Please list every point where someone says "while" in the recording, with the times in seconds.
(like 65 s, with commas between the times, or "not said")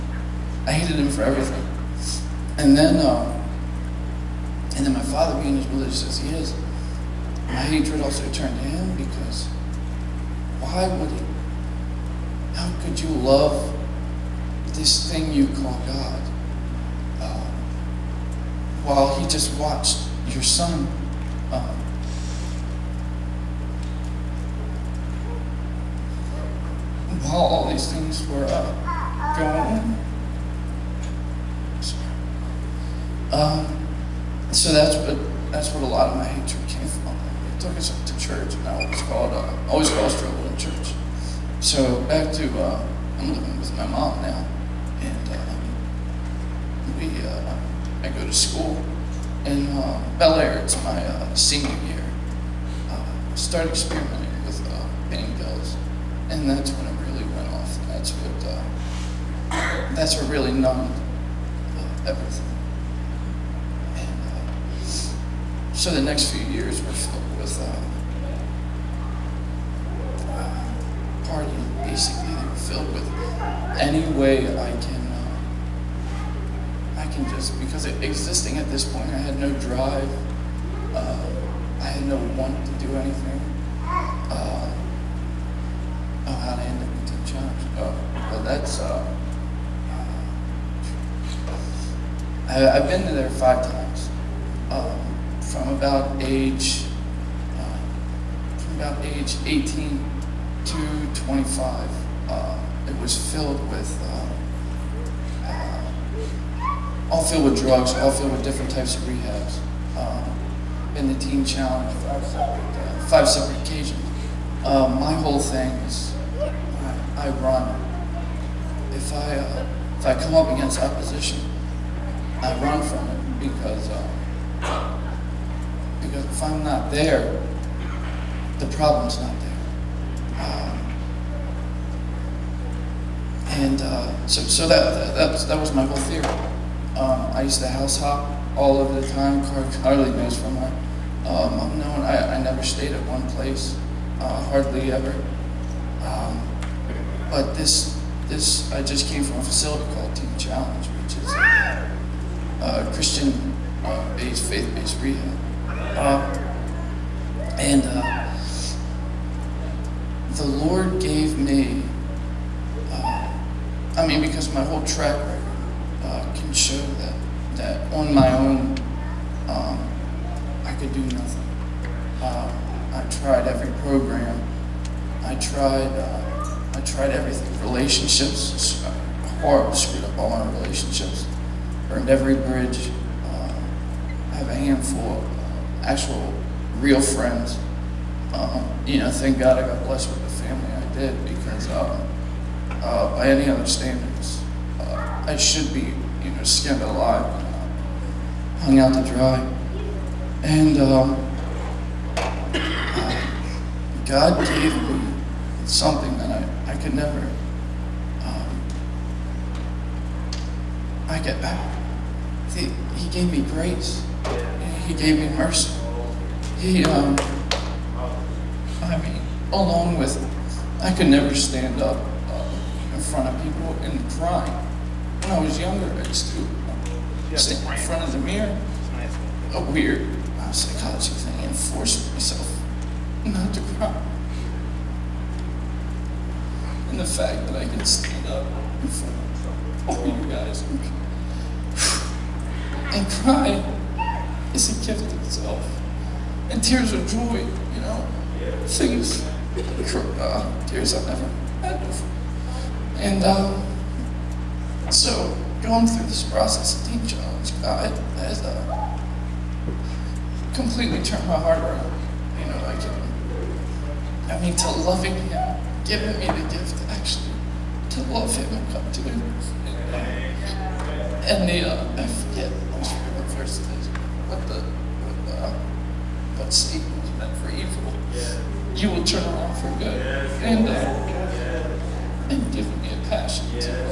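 18 s, 27 s.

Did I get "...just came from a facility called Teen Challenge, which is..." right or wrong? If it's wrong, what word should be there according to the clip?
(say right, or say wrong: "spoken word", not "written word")
right.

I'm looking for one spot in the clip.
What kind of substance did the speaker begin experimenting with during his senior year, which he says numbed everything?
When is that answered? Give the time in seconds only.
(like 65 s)
55 s.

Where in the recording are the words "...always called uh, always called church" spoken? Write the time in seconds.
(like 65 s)
38 s.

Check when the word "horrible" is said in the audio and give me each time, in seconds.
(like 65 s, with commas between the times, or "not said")
179 s.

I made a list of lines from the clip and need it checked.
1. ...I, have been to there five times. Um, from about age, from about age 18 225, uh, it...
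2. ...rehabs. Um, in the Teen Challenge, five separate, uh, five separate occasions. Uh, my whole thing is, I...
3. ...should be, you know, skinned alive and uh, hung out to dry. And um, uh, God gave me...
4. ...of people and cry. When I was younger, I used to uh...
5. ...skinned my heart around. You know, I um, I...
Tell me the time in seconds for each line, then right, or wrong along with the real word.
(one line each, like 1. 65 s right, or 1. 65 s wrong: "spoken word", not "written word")
1. 92 s right
2. 109 s right
3. 195 s right
4. 223 s right
5. 261 s wrong: "turned", not "skinned".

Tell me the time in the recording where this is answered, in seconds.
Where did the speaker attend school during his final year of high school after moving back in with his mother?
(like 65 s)
50 s.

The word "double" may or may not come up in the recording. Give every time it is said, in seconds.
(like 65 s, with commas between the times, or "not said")
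not said.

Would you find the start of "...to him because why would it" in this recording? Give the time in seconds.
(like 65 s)
8 s.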